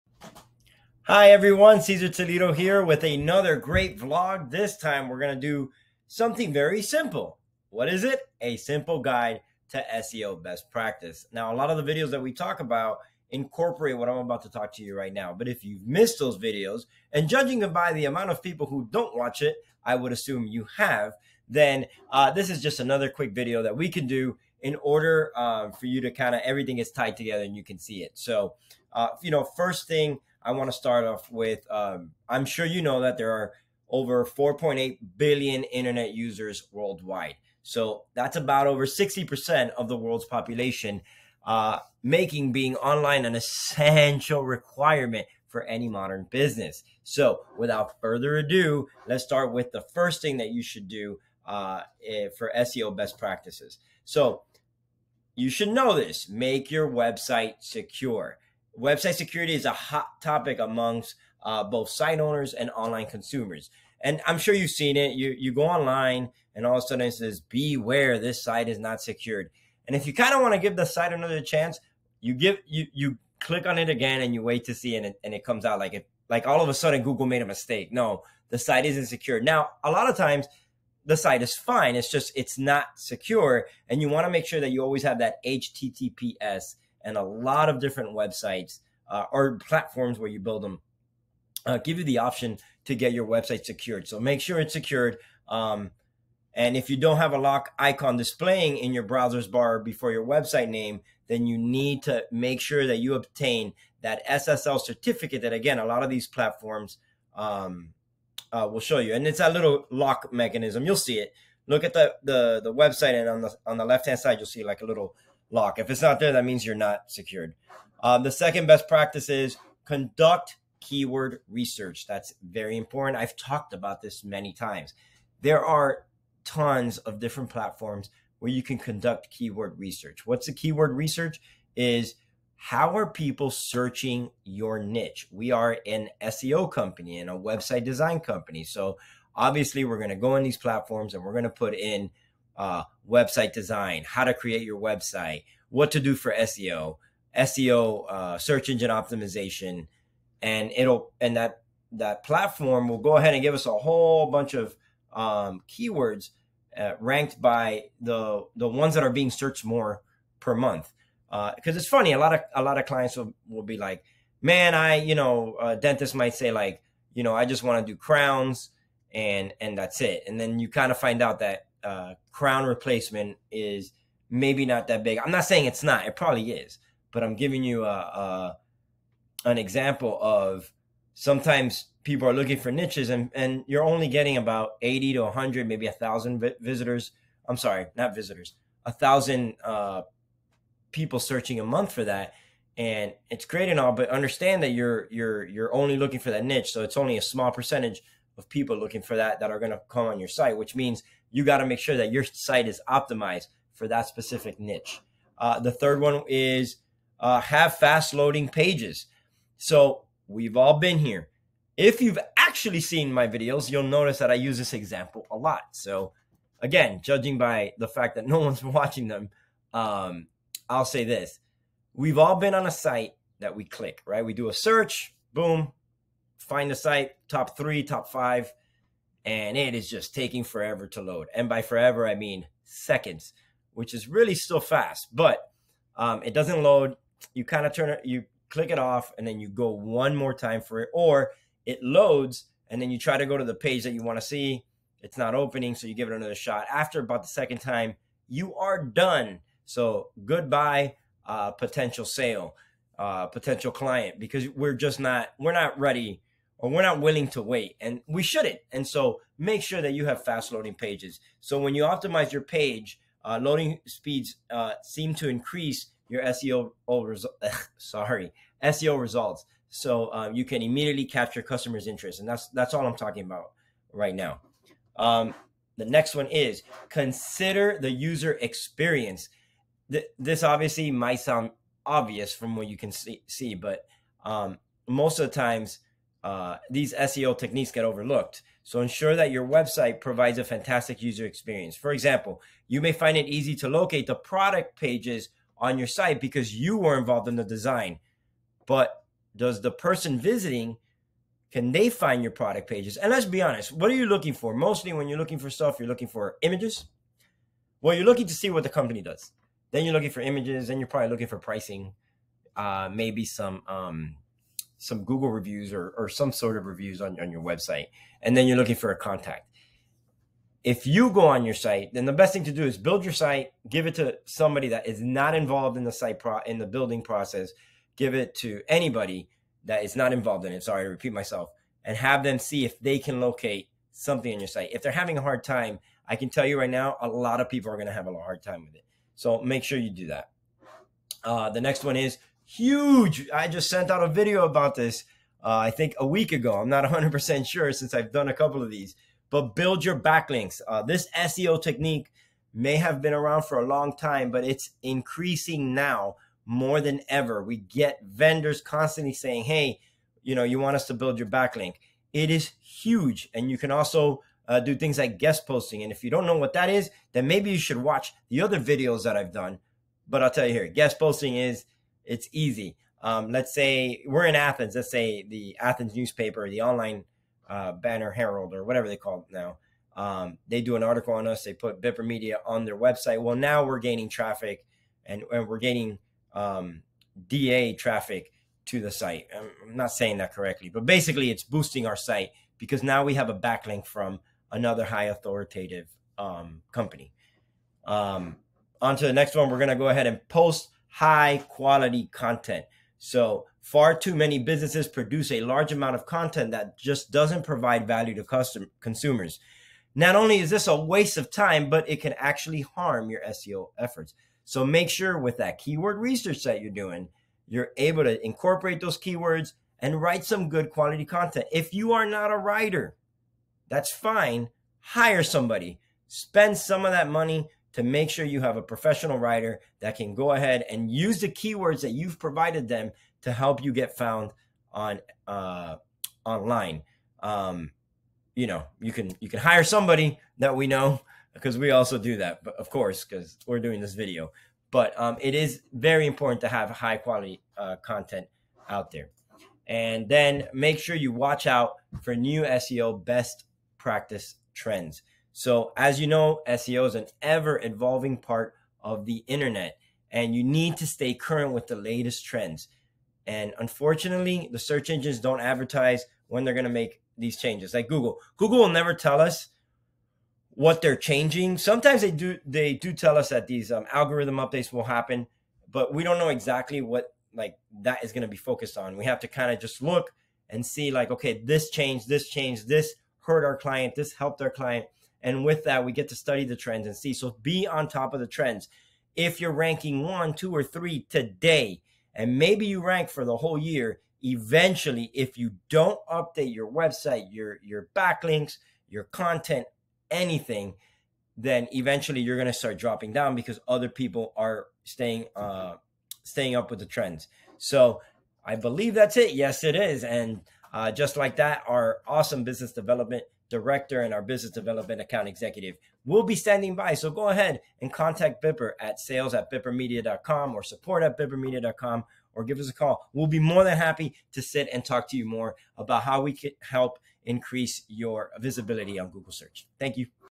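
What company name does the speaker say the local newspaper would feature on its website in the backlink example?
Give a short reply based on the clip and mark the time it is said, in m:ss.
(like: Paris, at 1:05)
Bipper Media, at 6:21.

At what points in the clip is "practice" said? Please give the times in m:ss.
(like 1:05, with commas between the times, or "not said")
0:10, 0:53, 1:58, 7:33.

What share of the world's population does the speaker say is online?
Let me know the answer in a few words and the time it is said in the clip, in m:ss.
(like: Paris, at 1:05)
over 60%, at 0:38.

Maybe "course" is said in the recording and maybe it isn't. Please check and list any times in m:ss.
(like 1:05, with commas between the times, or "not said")
7:22.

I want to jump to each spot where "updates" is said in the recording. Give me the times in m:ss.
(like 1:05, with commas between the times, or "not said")
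7:54, 8:16.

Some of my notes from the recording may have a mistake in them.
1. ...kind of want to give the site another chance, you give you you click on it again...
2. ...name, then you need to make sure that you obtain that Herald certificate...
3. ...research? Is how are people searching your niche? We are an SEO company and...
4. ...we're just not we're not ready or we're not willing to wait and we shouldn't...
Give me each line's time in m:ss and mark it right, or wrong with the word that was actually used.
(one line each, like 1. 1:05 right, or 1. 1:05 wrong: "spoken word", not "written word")
1. 1:10 right
2. 1:40 wrong: "SSL", not "Herald"
3. 2:10 right
4. 4:14 right.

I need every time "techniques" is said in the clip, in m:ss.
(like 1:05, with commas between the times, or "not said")
4:47, 5:51.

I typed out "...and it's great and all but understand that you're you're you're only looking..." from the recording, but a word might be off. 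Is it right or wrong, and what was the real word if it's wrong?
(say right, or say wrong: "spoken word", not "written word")
right.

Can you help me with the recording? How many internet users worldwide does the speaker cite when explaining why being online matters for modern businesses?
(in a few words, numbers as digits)
4.8 billion.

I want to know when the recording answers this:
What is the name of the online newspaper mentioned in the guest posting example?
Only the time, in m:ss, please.
6:17.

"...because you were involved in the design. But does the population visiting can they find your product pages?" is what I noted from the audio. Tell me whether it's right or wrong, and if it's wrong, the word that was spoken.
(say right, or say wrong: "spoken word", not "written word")
wrong: "person", not "population".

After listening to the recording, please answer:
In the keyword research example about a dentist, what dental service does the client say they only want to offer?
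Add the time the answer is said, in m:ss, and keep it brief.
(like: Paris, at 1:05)
crowns, at 2:47.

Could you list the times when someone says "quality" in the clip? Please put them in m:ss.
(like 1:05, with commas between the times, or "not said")
6:41, 7:00, 7:26.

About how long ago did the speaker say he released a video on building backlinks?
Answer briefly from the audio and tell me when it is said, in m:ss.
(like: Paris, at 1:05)
a week ago, at 5:45.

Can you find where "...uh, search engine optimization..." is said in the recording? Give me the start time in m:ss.
2:28.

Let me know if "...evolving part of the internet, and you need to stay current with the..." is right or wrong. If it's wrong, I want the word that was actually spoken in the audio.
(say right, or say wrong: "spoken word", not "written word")
right.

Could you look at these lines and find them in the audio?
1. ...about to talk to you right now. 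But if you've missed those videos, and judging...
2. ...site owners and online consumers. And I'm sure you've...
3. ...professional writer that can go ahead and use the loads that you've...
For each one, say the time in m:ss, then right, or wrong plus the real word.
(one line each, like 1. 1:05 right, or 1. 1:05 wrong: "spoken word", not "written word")
1. 0:14 right
2. 1:01 right
3. 7:08 wrong: "keywords", not "loads".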